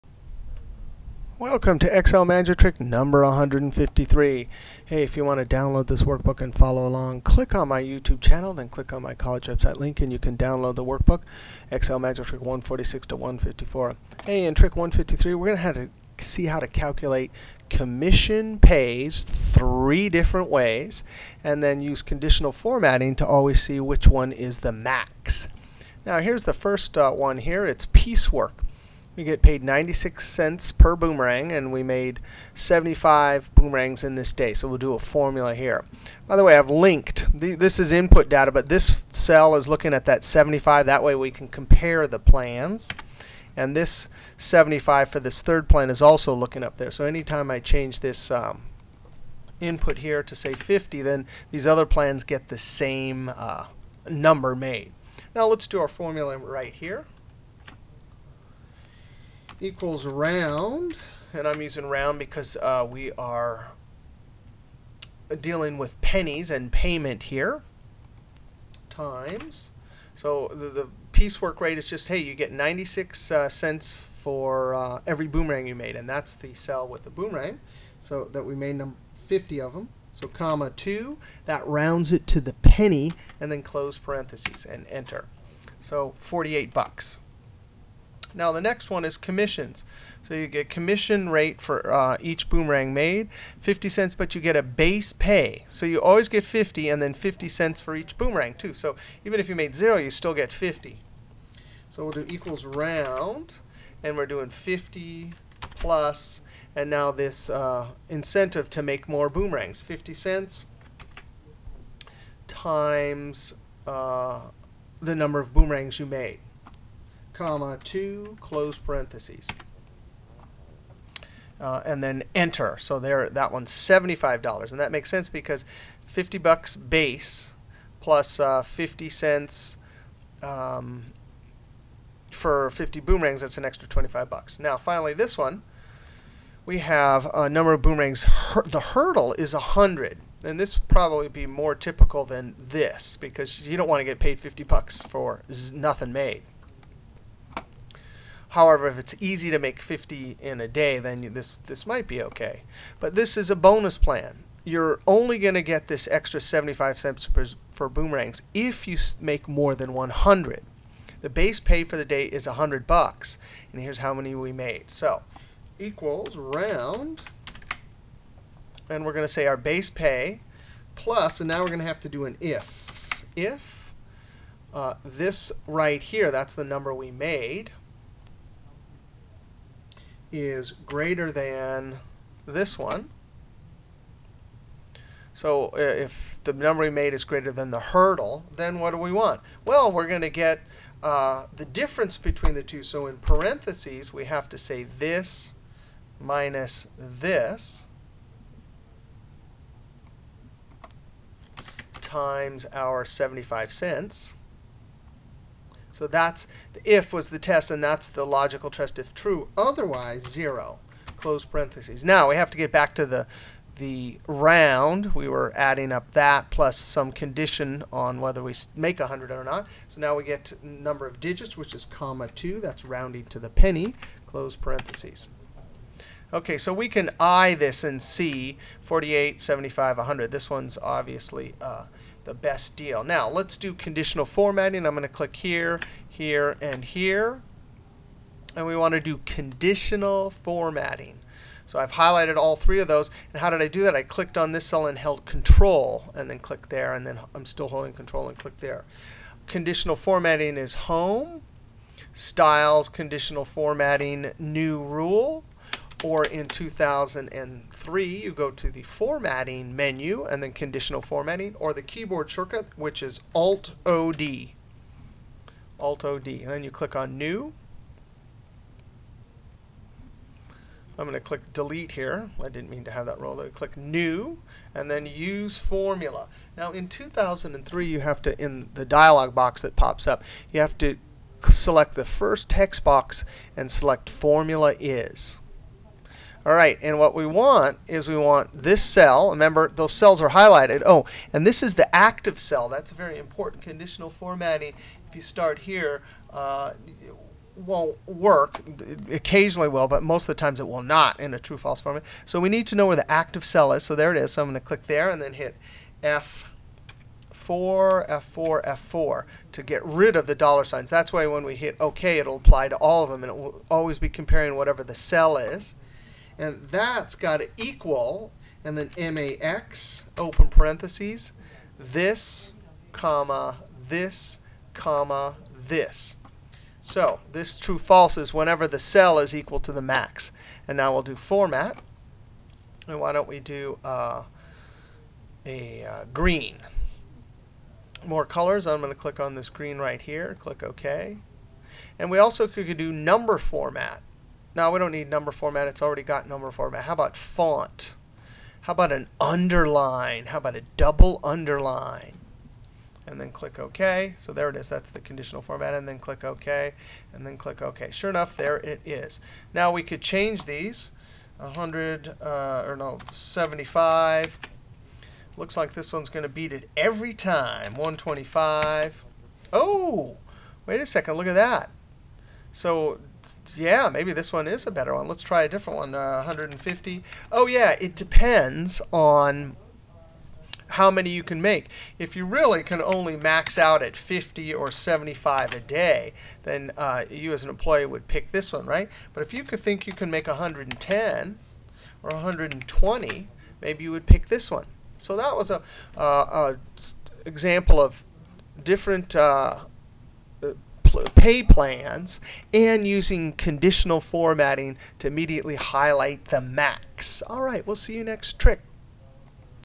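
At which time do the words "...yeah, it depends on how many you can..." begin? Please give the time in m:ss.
6:17.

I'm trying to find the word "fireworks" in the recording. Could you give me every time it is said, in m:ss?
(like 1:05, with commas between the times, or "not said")
not said.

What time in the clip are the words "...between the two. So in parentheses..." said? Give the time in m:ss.
3:12.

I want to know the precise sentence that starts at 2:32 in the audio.
But this is a bonus plan.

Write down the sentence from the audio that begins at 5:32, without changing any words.
And why don't we do uh, a uh, green?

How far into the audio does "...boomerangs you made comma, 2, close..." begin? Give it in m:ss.
1:55.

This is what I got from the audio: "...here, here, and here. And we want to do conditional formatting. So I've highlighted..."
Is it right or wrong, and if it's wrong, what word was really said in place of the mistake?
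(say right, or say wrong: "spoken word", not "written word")
right.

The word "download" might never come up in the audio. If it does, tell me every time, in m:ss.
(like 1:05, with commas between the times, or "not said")
0:05, 0:10.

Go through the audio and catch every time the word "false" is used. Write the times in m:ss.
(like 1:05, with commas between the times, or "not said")
5:01, 5:27.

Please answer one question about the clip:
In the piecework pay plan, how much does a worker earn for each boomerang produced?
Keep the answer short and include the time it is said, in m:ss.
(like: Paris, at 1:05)
96 cents, at 0:29.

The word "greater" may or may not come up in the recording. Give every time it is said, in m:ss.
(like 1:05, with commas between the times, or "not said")
3:00, 3:07.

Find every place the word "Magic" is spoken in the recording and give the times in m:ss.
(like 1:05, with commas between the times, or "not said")
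0:02, 0:11.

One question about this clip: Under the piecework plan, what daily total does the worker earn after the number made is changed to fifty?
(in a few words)
$48.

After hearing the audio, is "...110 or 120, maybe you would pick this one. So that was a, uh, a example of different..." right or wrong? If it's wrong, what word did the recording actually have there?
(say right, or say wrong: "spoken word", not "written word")
right.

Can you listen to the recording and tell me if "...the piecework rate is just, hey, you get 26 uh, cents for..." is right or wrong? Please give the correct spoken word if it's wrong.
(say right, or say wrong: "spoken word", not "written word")
wrong: "96", not "26".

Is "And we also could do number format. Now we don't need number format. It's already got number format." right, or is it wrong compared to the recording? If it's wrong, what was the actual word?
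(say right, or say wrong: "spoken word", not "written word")
right.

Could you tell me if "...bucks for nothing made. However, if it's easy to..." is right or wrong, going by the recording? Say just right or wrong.
right.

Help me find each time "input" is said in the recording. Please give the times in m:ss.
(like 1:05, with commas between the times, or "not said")
0:37, 0:49.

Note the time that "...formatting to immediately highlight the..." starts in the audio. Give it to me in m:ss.
6:44.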